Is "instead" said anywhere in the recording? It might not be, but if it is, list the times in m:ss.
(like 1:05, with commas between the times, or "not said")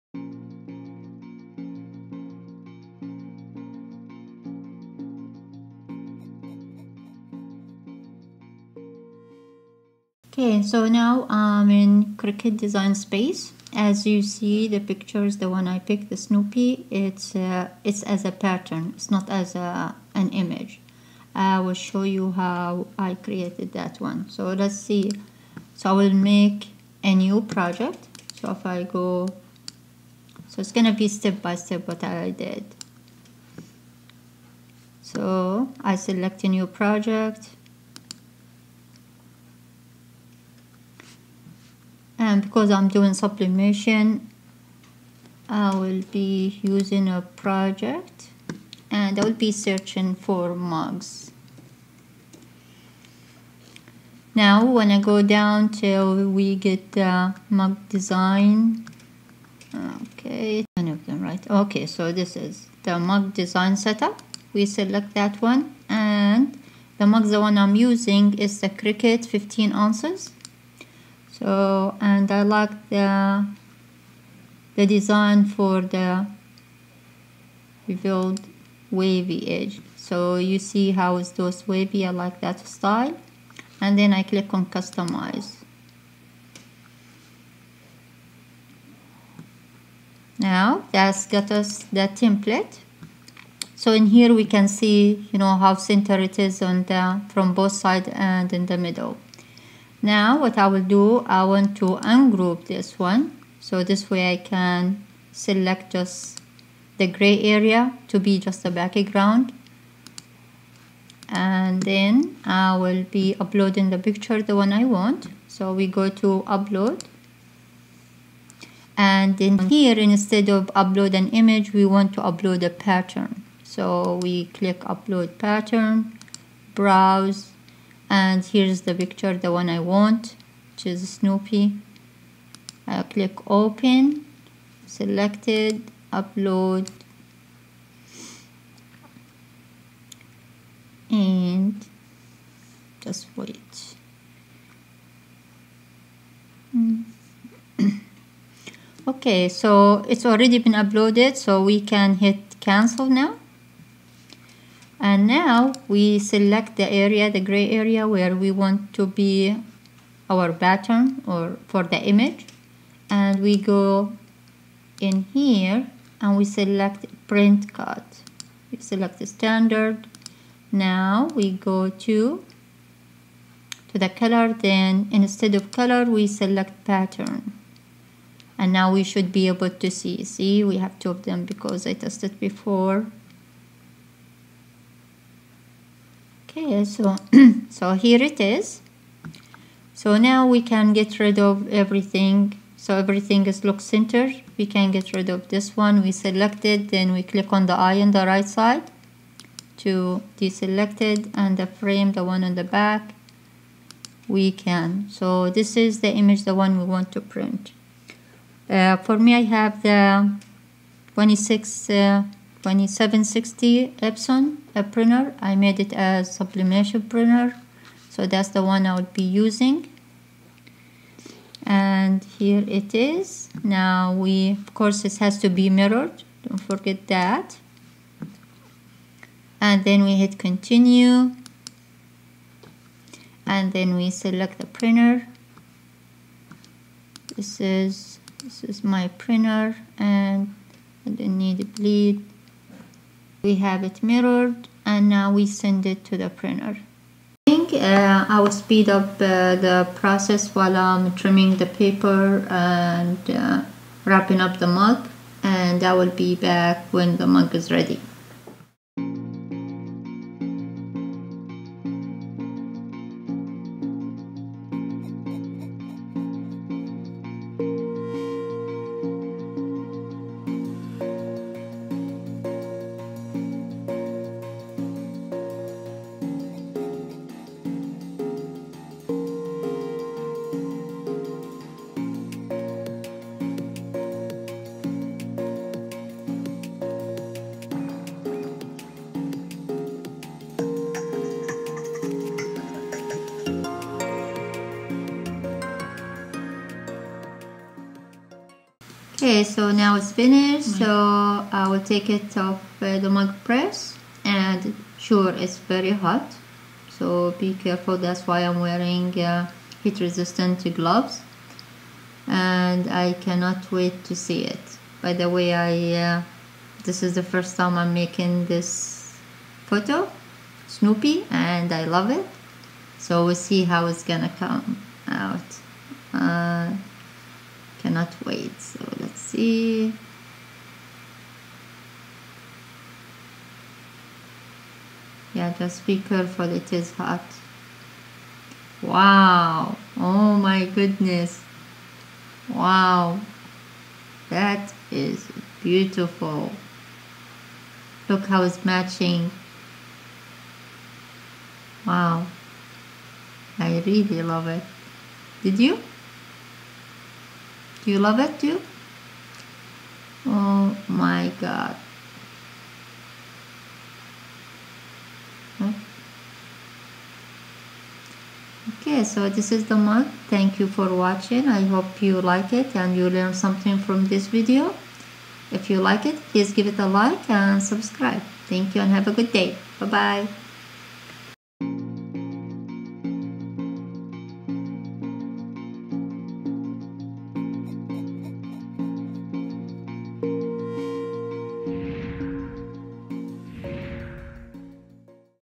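1:59, 2:55.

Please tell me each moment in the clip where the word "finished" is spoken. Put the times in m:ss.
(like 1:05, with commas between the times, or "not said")
5:00.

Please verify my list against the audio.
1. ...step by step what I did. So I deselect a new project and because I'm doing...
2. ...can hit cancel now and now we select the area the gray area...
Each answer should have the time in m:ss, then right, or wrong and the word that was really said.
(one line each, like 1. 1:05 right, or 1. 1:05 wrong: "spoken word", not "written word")
1. 0:31 wrong: "select", not "deselect"
2. 2:31 right.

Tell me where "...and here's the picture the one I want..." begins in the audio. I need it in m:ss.
2:08.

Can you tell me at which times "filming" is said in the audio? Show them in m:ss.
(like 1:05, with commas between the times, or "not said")
not said.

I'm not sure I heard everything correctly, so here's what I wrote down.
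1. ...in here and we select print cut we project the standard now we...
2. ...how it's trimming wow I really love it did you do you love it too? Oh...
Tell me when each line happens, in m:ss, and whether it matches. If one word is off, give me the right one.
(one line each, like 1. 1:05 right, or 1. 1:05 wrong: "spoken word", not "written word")
1. 2:45 wrong: "select", not "project"
2. 5:48 wrong: "matching", not "trimming".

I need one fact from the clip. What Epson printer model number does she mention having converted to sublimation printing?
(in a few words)
2760.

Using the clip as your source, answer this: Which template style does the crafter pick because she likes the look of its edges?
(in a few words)
revealed wavy edge.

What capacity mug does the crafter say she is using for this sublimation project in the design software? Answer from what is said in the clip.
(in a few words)
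15 ounces.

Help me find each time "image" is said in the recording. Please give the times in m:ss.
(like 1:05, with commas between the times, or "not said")
0:20, 2:01, 2:41, 3:26.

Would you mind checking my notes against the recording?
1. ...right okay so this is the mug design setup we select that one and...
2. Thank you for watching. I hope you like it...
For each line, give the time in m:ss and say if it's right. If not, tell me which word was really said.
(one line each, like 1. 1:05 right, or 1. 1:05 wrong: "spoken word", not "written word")
1. 1:01 right
2. 6:10 right.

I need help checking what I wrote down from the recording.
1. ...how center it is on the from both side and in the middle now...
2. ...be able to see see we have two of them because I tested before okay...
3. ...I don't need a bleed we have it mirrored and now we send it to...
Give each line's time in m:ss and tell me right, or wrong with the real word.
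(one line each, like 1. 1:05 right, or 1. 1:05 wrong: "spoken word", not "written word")
1. 1:35 right
2. 2:59 right
3. 4:01 right.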